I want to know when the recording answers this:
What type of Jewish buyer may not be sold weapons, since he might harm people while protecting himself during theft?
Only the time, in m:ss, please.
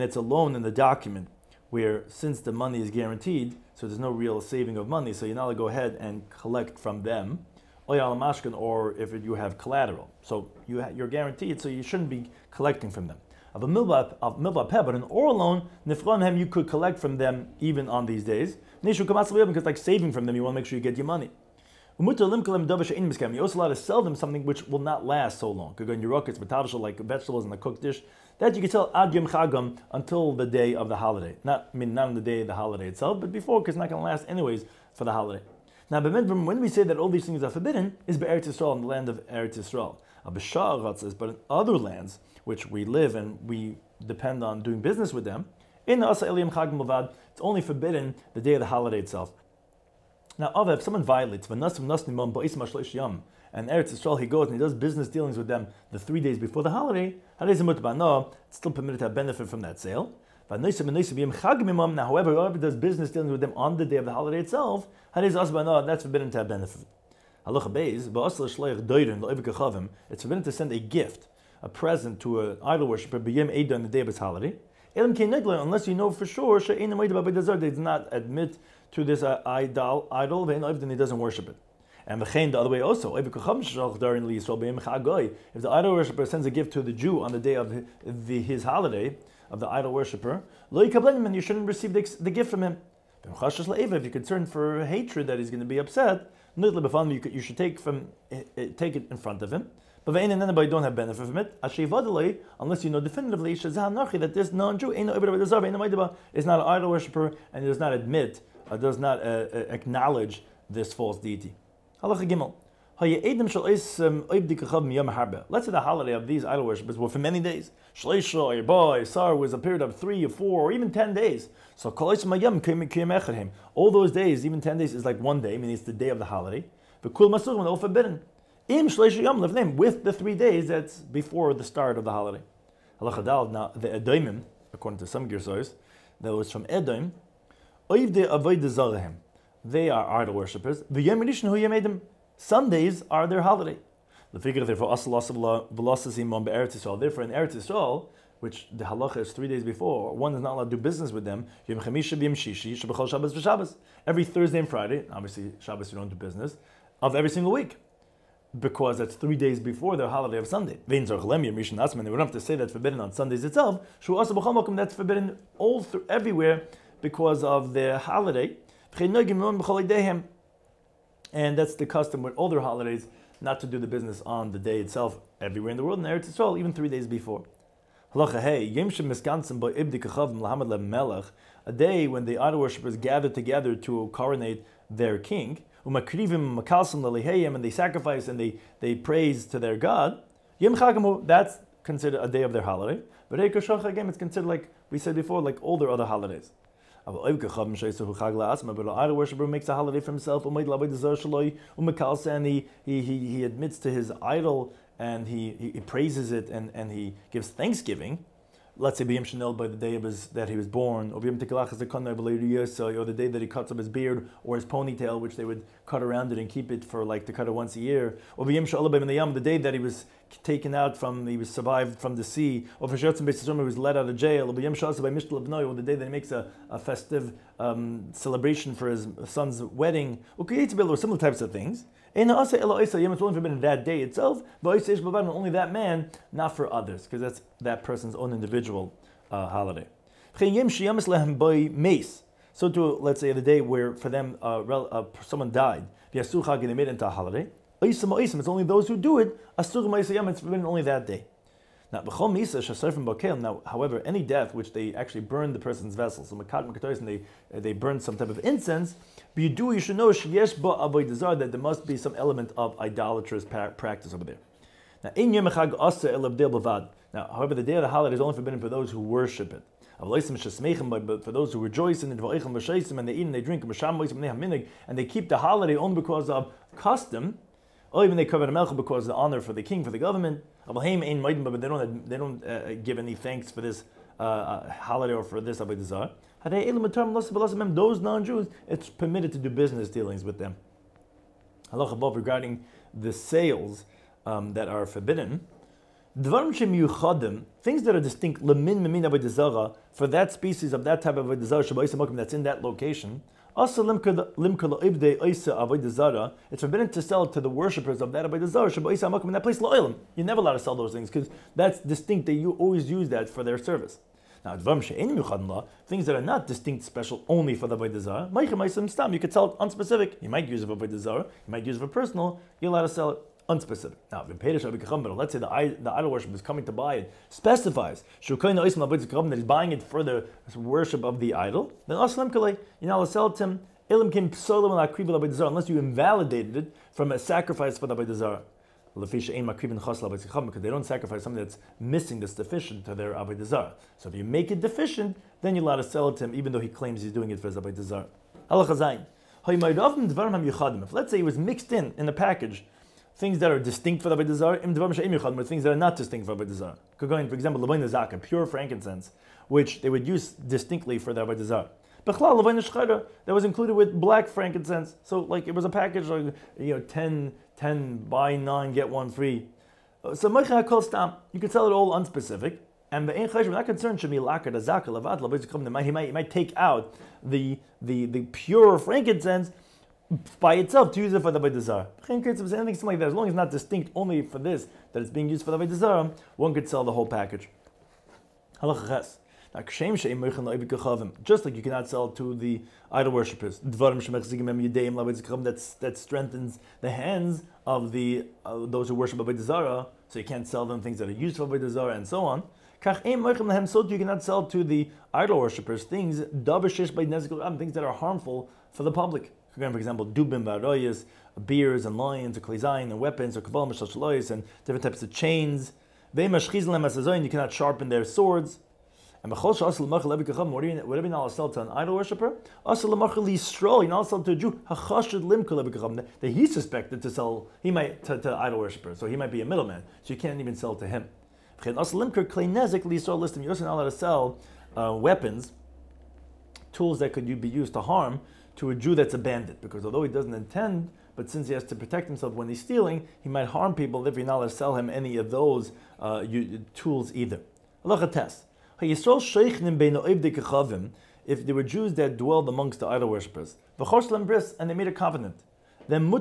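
7:19.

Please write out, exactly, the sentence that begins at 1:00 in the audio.
Now, however, whoever does business dealing with them on the day of the holiday itself, that's forbidden to have benefit.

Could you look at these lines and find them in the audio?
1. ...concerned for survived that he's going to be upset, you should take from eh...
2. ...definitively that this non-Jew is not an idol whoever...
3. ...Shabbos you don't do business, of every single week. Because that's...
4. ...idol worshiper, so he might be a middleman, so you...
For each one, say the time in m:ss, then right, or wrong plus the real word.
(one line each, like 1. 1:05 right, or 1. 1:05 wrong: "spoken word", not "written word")
1. 1:34 wrong: "hatred", not "survived"
2. 1:42 wrong: "worshiper", not "whoever"
3. 2:35 right
4. 7:08 right.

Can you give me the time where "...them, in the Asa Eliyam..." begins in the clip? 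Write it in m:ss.
0:45.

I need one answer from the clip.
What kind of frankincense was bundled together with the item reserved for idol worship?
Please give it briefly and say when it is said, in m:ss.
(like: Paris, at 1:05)
black frankincense, at 6:03.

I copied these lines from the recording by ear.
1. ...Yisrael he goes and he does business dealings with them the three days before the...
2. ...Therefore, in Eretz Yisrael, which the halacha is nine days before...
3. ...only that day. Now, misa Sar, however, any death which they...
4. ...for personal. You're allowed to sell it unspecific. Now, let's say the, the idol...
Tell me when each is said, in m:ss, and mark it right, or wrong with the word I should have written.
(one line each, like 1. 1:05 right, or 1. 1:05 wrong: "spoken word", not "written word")
1. 0:53 right
2. 2:24 wrong: "three", not "nine"
3. 4:10 wrong: "Now", not "Sar"
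4. 5:21 right.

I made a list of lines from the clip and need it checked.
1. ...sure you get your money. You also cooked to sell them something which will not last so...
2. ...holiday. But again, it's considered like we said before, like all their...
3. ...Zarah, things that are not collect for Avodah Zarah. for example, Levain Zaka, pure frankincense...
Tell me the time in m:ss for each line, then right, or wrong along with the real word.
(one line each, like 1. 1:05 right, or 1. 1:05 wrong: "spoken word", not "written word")
1. 0:20 wrong: "allowed", not "cooked"
2. 3:12 right
3. 5:54 wrong: "distinct", not "collect".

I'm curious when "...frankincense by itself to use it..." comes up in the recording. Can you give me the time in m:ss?
6:18.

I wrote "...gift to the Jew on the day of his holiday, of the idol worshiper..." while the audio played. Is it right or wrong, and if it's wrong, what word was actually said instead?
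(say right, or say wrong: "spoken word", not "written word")
right.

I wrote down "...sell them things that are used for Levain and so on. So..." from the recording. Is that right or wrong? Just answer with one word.
wrong.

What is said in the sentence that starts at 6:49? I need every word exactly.
Again, for example, dubim v'aroyas, beers and lions, or klizayin and weapons, or kabbalah mishal and different types of chains.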